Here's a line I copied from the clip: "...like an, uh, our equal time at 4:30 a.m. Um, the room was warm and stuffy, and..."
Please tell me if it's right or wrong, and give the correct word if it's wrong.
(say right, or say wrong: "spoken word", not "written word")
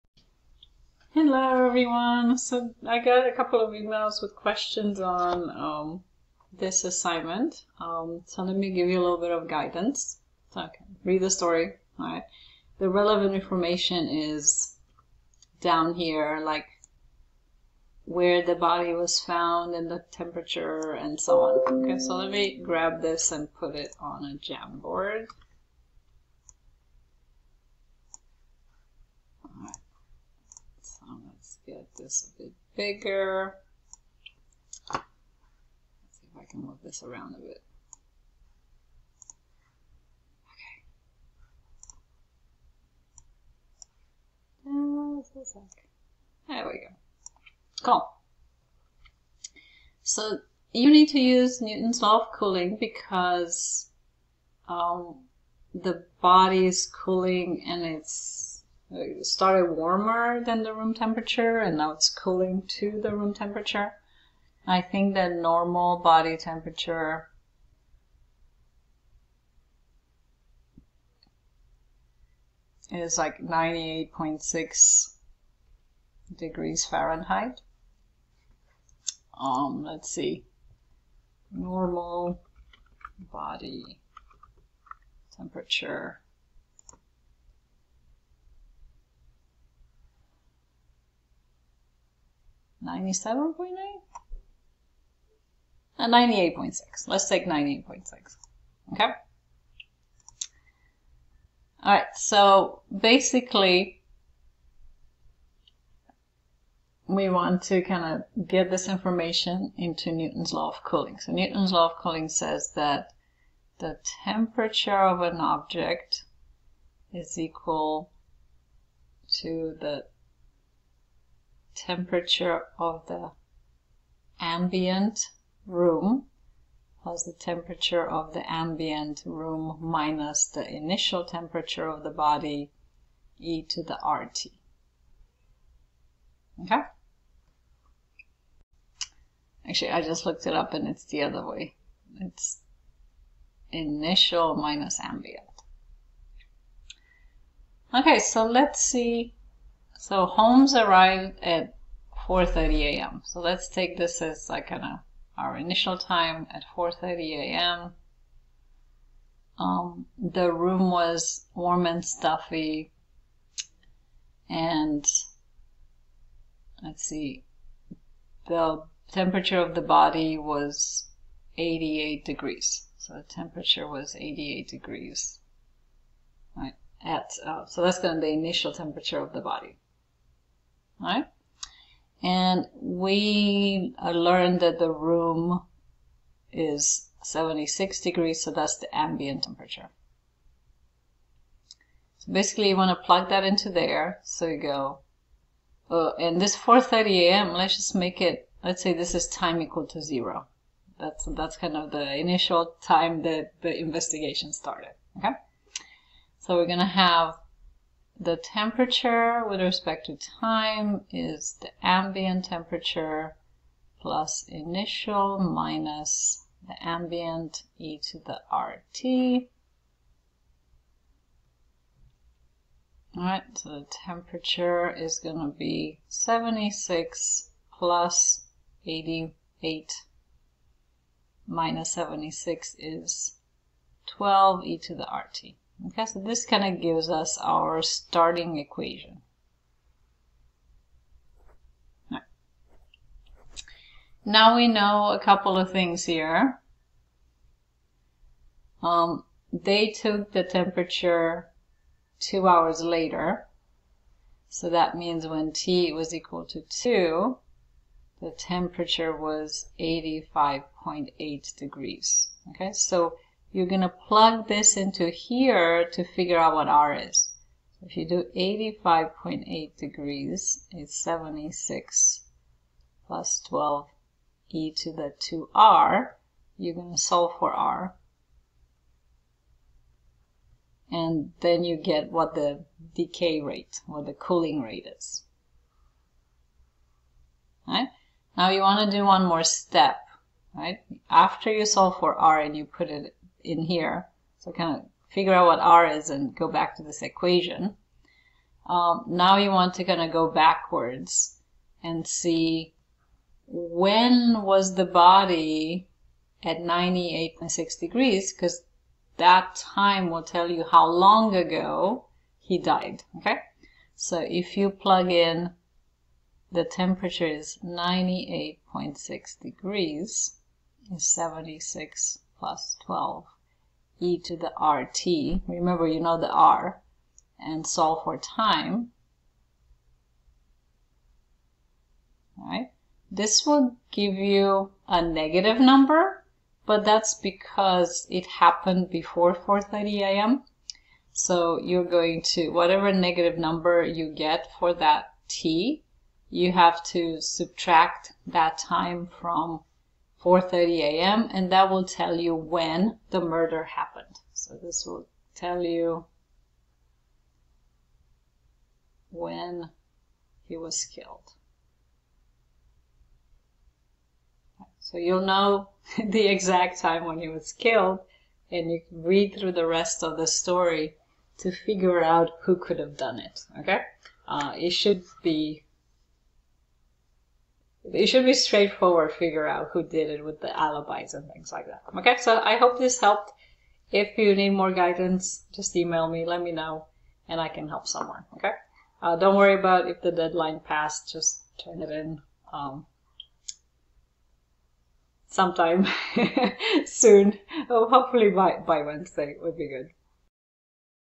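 wrong: "initial", not "equal".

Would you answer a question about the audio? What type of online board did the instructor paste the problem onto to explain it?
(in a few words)
Jamboard.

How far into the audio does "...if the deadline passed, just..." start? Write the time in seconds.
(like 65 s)
389 s.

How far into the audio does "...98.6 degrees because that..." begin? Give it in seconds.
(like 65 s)
306 s.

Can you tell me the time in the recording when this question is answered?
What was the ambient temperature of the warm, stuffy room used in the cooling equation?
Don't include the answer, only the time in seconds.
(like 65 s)
187 s.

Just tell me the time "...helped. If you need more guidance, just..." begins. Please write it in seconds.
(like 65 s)
382 s.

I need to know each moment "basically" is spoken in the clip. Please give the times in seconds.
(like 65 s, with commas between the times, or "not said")
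102 s, 192 s.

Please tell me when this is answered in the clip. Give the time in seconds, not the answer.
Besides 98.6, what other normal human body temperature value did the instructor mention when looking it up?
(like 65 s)
92 s.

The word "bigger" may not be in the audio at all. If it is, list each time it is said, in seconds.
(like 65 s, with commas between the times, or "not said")
32 s.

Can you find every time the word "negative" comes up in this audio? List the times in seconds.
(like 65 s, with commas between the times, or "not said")
335 s, 342 s.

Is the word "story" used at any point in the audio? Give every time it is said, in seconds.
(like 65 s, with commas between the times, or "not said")
11 s, 370 s.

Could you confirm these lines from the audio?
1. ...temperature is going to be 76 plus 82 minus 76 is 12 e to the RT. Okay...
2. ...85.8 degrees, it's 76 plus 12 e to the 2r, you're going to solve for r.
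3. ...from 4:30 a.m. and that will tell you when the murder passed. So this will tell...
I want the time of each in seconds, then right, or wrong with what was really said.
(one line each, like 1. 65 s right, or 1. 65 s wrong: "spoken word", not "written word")
1. 223 s wrong: "88", not "82"
2. 268 s right
3. 349 s wrong: "happened", not "passed".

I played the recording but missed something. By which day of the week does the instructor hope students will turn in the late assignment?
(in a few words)
Wednesday.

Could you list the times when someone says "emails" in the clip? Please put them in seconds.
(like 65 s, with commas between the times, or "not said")
3 s, 385 s.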